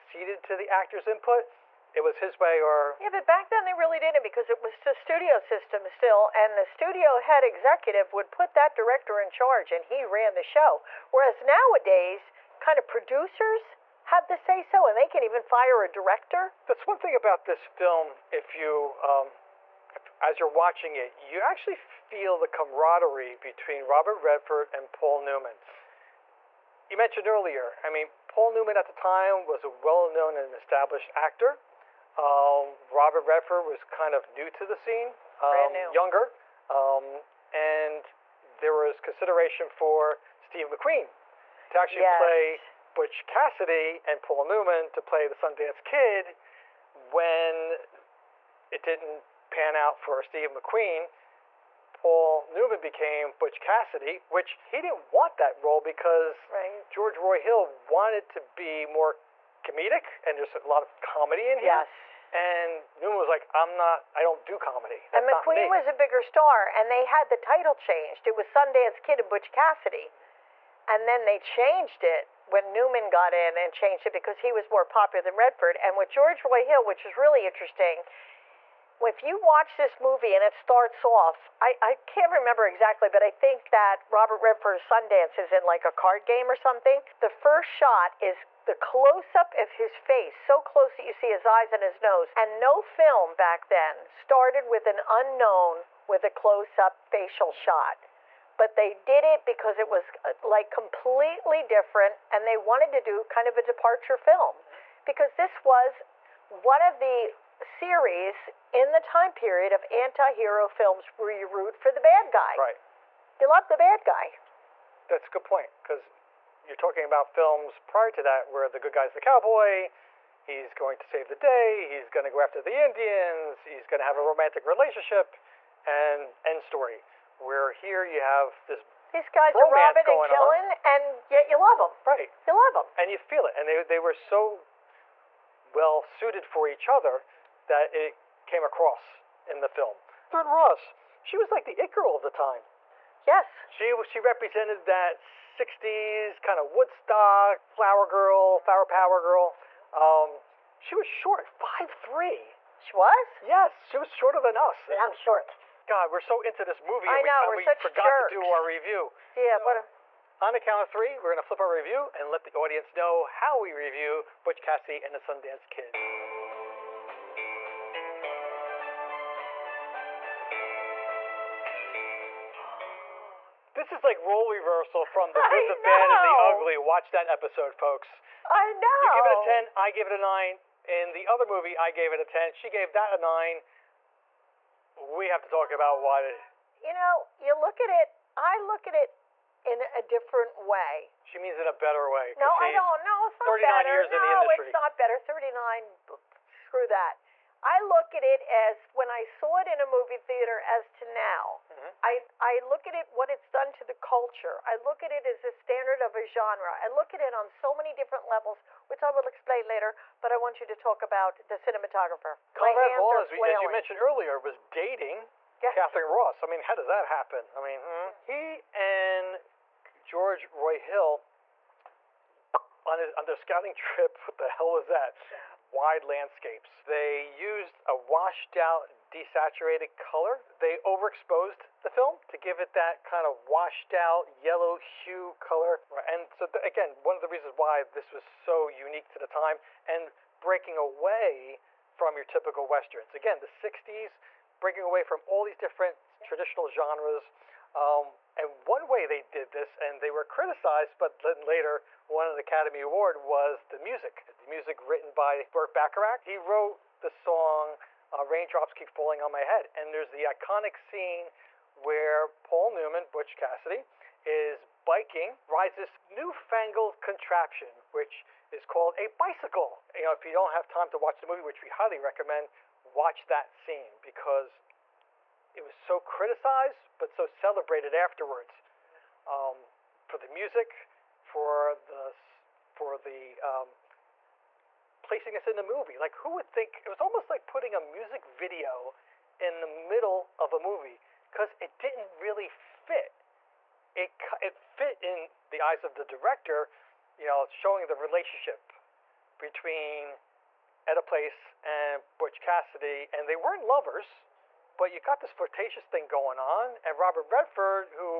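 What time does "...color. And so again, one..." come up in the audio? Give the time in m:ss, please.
3:55.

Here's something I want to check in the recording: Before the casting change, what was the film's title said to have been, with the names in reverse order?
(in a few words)
Sundance Kid and Butch Cassidy.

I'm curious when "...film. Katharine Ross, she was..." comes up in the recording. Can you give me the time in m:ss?
2:19.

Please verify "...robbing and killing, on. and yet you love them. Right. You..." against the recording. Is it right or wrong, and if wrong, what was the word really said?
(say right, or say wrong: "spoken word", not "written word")
right.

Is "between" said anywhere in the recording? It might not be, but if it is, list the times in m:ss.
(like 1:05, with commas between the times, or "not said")
0:23, 4:59.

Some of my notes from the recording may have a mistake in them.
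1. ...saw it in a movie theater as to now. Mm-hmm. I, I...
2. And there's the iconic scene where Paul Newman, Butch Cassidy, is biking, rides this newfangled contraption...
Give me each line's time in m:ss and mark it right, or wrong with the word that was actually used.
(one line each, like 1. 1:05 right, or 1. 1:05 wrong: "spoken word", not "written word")
1. 3:19 right
2. 4:19 right.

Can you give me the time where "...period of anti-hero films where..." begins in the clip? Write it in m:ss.
1:49.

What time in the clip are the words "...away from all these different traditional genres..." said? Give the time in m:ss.
4:04.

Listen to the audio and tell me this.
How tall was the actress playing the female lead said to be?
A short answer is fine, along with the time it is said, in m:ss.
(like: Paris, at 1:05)
5'3", at 2:31.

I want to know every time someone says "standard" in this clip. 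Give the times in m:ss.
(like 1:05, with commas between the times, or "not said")
3:25.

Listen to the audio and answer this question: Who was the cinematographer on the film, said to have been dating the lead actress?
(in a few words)
Conrad Hall.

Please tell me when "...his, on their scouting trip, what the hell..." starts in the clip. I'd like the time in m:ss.
3:42.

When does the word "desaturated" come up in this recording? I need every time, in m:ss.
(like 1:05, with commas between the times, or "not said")
3:49.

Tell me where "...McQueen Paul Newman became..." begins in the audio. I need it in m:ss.
0:50.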